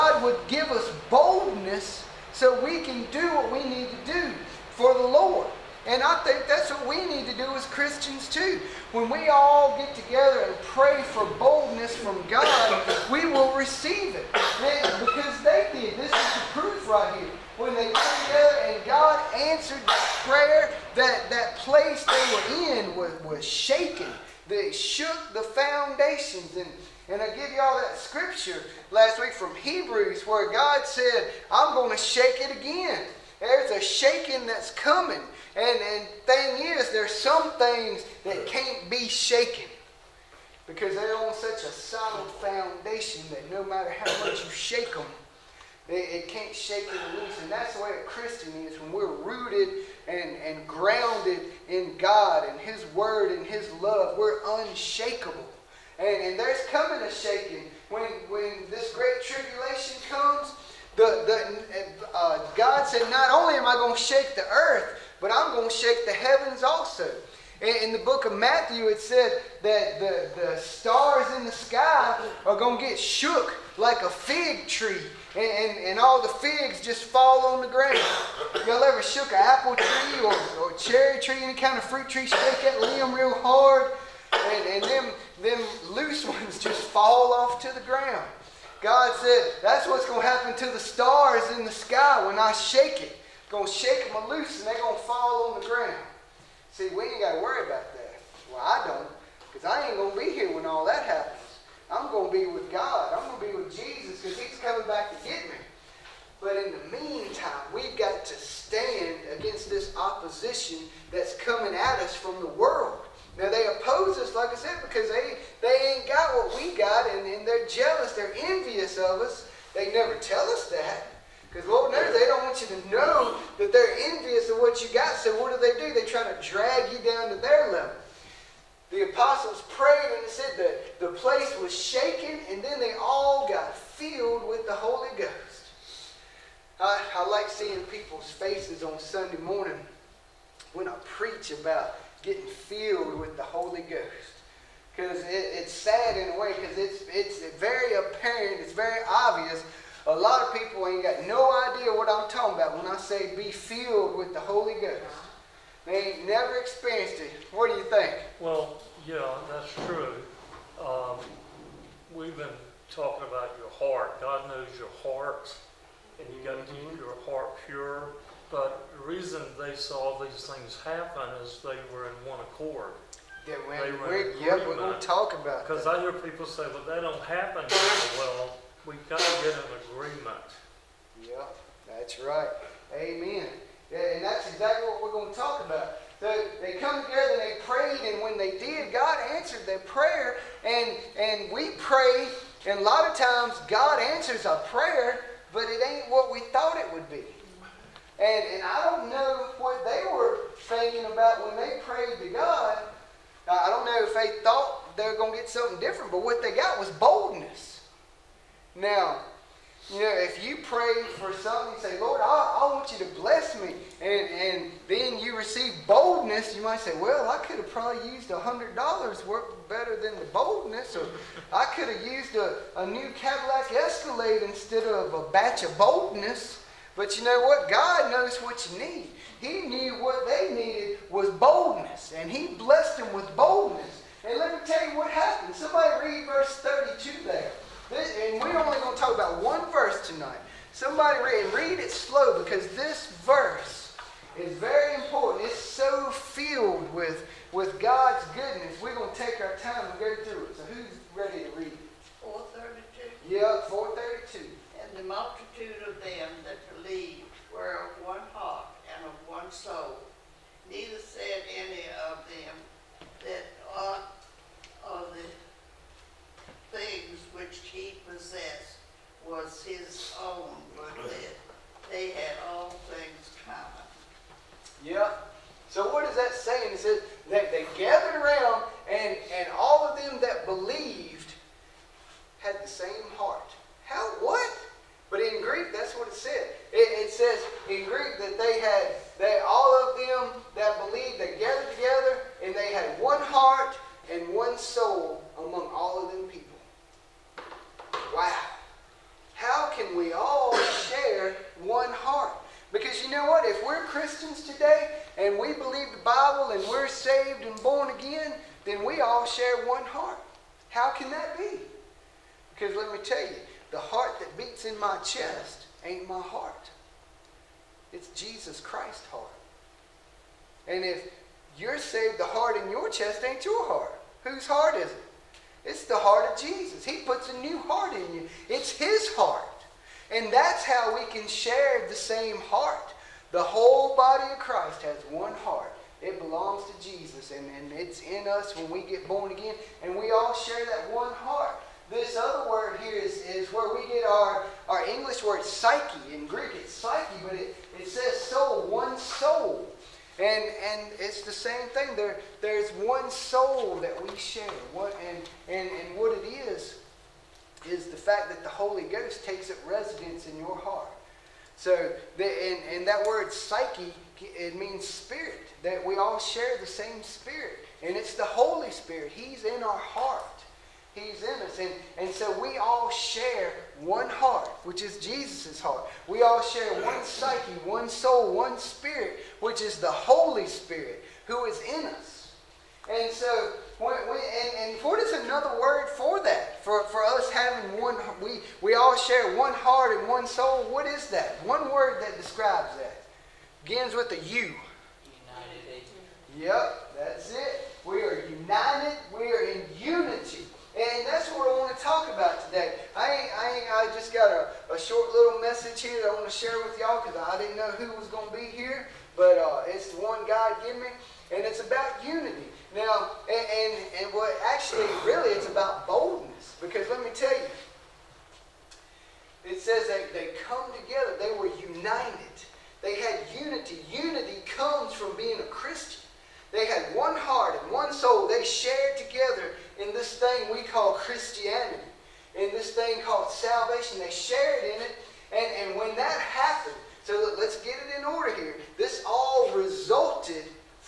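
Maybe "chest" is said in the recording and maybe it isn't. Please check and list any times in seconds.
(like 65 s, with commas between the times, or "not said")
315 s, 322 s.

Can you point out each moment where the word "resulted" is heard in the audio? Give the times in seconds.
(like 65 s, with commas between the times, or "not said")
439 s.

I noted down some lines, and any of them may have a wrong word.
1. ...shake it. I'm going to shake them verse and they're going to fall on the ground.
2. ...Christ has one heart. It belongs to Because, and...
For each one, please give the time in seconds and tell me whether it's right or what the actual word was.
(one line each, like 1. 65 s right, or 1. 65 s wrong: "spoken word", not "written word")
1. 92 s wrong: "loose", not "verse"
2. 334 s wrong: "Jesus", not "Because".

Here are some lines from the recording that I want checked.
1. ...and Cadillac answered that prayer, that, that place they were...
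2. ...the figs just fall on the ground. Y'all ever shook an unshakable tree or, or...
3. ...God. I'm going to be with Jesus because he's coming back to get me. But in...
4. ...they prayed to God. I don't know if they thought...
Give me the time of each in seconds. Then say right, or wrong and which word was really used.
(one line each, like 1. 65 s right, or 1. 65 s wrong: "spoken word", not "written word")
1. 18 s wrong: "God", not "Cadillac"
2. 76 s wrong: "apple", not "unshakable"
3. 102 s right
4. 201 s right.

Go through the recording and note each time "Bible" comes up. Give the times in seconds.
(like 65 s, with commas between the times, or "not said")
306 s.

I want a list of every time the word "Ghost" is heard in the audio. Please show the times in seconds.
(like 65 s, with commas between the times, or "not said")
135 s, 143 s, 154 s, 358 s.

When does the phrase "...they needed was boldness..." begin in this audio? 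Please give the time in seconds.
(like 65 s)
230 s.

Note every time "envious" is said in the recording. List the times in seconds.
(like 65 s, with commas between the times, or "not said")
118 s, 123 s.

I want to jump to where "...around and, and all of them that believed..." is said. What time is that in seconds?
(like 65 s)
278 s.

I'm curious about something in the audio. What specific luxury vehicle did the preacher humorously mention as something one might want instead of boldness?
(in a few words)
Cadillac Escalade.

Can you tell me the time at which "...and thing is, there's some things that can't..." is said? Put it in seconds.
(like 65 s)
35 s.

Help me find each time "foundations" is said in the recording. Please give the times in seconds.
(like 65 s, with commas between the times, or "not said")
25 s, 42 s.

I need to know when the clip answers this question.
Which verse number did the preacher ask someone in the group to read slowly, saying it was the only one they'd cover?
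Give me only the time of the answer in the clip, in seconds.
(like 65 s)
236 s.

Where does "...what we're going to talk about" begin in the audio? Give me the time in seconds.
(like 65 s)
184 s.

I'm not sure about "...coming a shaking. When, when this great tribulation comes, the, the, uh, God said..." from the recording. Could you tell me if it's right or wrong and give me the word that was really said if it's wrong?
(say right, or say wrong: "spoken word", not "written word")
right.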